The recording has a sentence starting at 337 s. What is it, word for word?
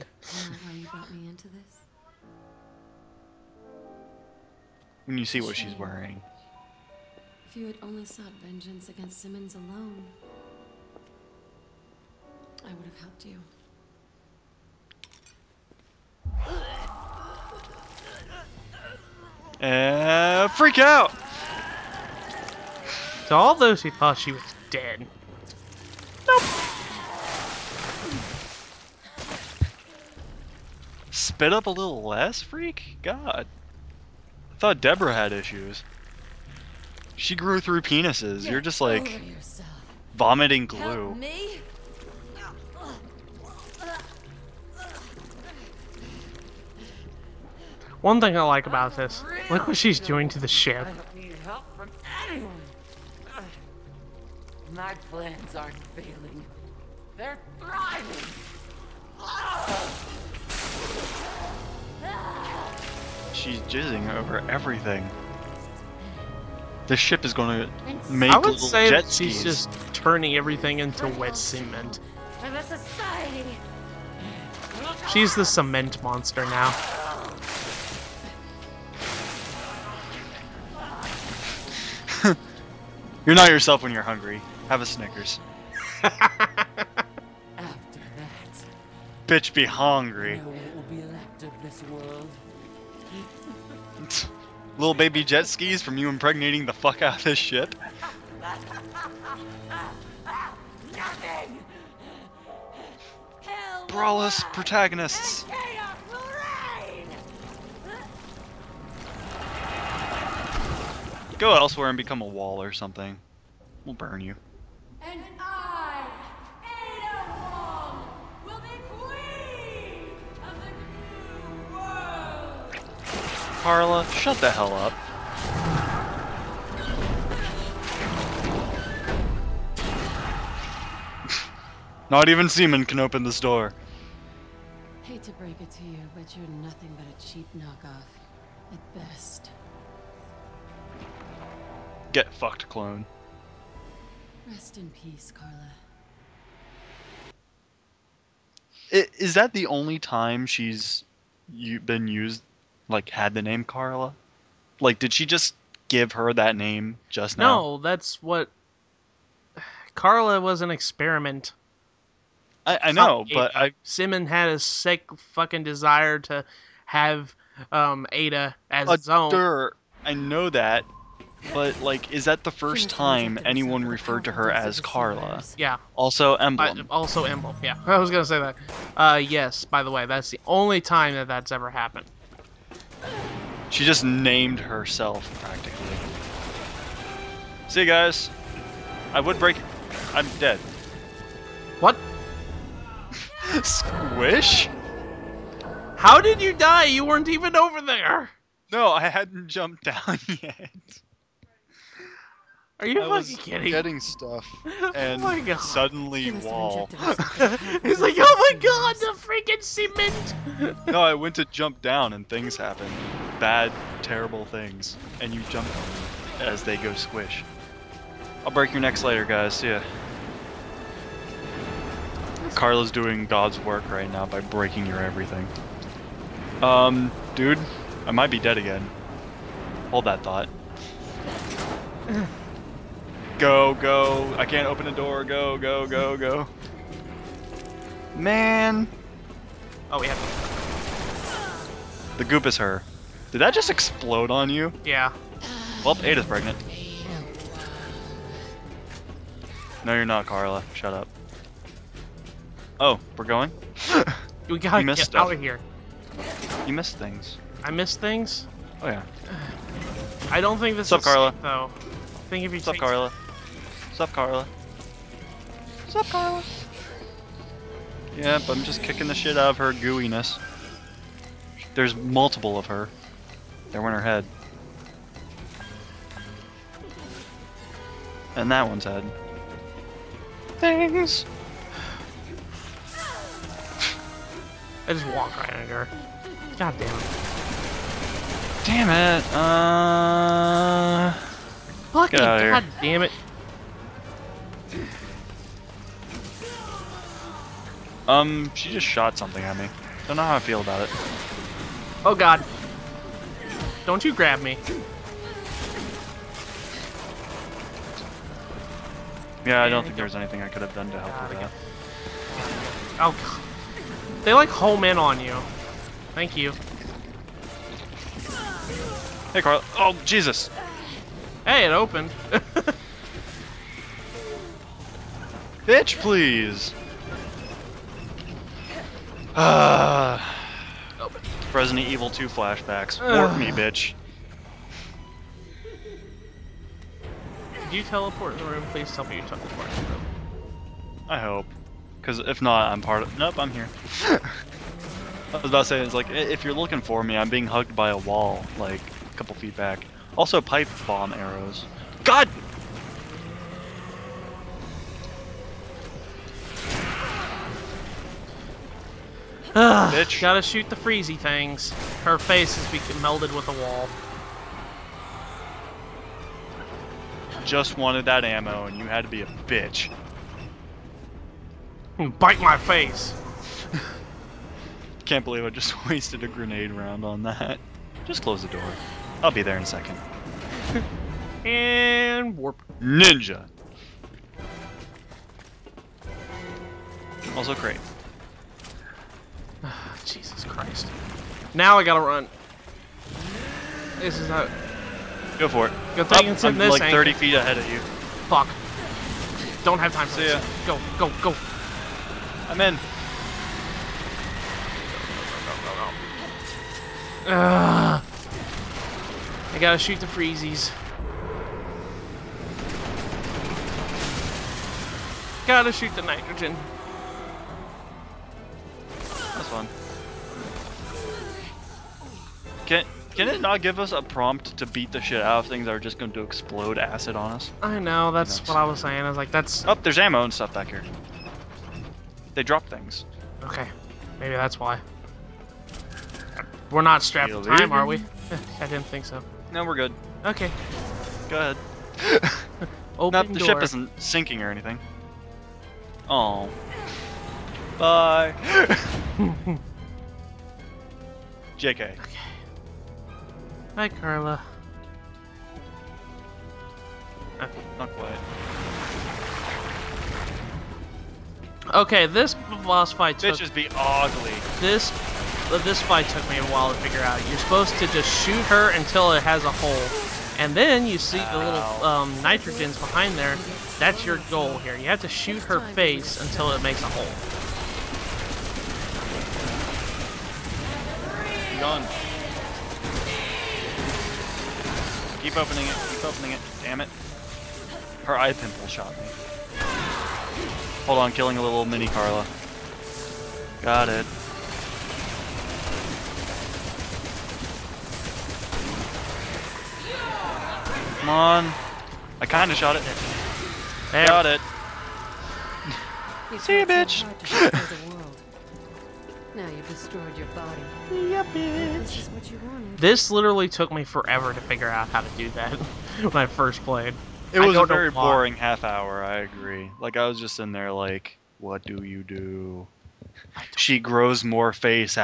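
Did you teleport in the room?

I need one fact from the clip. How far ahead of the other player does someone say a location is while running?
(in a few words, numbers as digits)
30 feet.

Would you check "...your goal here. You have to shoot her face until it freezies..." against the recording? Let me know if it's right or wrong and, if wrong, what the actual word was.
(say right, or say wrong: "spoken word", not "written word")
wrong: "makes", not "freezies".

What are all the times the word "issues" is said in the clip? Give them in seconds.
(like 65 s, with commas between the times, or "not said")
35 s.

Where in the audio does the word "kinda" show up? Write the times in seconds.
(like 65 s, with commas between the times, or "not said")
502 s.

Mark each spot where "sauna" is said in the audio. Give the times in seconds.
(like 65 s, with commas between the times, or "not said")
not said.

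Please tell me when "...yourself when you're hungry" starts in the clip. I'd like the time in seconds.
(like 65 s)
83 s.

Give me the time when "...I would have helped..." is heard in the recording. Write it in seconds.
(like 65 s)
12 s.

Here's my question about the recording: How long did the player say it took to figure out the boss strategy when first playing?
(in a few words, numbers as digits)
half hour.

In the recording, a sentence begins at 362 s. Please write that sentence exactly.
Her face is melded with a wall.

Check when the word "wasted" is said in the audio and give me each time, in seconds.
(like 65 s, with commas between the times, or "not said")
375 s.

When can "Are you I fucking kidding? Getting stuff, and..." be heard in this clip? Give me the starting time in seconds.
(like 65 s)
202 s.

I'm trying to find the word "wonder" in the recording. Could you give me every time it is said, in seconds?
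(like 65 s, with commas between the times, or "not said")
not said.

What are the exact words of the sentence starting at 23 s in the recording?
To all those who thought she was dead, nope.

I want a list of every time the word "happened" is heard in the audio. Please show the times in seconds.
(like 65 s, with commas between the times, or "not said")
181 s, 212 s.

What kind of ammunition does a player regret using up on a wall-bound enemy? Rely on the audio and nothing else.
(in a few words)
grenade round.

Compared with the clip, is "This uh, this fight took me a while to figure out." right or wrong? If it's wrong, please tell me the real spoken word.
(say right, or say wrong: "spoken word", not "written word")
right.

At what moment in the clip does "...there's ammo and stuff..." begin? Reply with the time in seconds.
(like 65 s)
429 s.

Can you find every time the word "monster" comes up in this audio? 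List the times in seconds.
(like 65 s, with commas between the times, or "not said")
76 s.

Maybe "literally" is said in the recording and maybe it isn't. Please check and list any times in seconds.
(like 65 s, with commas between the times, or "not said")
513 s.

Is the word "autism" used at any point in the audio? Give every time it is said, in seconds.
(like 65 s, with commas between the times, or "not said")
not said.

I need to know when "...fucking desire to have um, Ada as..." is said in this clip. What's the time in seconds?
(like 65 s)
165 s.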